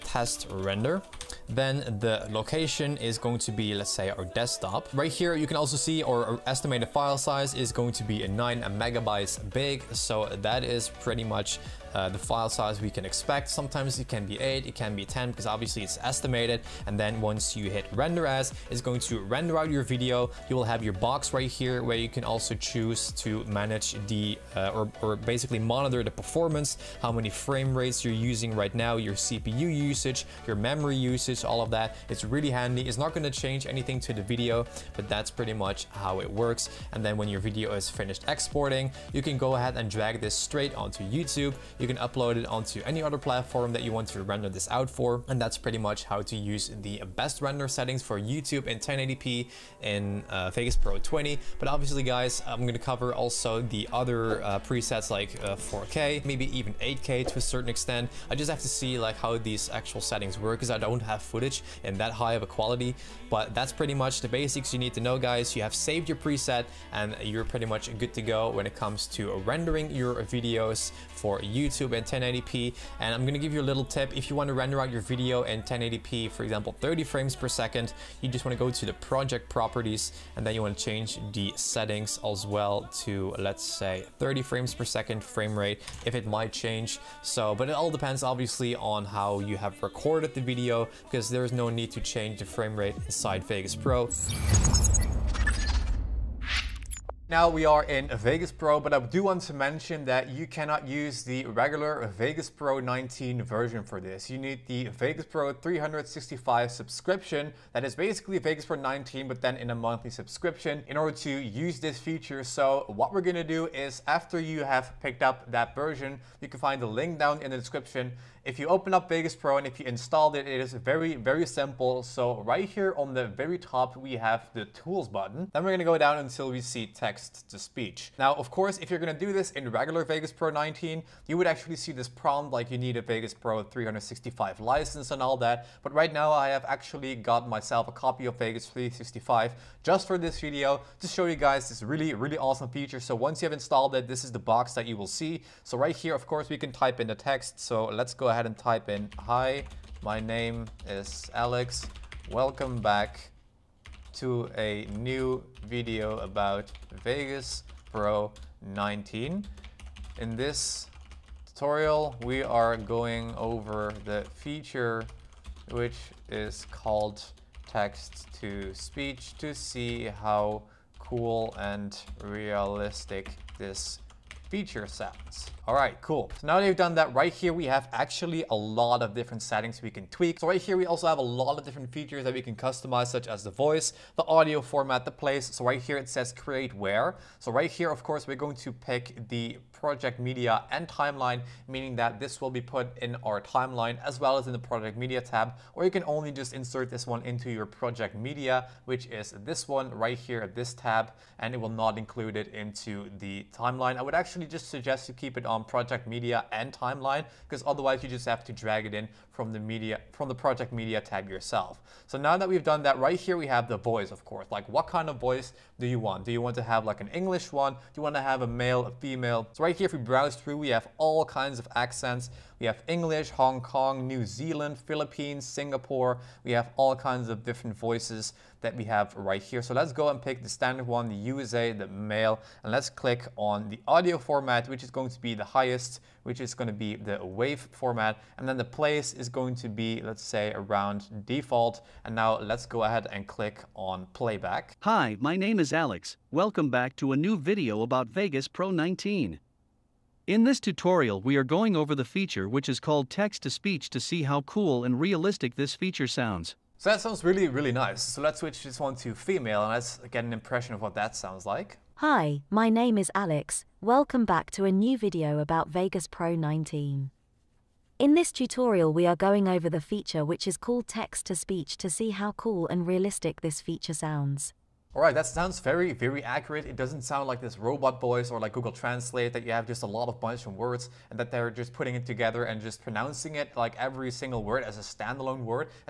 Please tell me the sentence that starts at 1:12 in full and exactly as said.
And I'm gonna give you a little tip.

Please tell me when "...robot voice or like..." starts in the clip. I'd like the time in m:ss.
4:37.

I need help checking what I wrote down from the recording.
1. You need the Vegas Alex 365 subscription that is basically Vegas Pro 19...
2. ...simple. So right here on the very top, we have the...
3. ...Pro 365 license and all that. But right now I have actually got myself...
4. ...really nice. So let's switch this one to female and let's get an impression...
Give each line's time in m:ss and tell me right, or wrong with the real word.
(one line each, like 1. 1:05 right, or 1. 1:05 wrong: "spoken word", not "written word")
1. 1:44 wrong: "Pro", not "Alex"
2. 2:01 right
3. 2:13 right
4. 4:17 right.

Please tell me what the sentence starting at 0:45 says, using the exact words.
And that's pretty much how to use the best render settings for YouTube in 1080p in uh, Vegas Pro 20.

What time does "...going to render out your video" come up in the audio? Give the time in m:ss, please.
0:18.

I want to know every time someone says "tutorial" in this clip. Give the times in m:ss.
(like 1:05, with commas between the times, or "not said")
2:41, 4:10, 4:28.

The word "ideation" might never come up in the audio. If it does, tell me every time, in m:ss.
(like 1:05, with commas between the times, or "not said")
not said.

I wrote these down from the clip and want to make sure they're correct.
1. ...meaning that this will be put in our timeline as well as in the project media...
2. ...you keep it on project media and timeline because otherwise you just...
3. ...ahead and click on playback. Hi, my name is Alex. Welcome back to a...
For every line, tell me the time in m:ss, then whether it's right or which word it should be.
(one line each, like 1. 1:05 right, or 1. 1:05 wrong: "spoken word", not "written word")
1. 3:11 right
2. 3:25 right
3. 4:02 right.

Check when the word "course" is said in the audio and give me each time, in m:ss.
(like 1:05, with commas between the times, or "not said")
2:08, 2:26, 3:08, 3:34.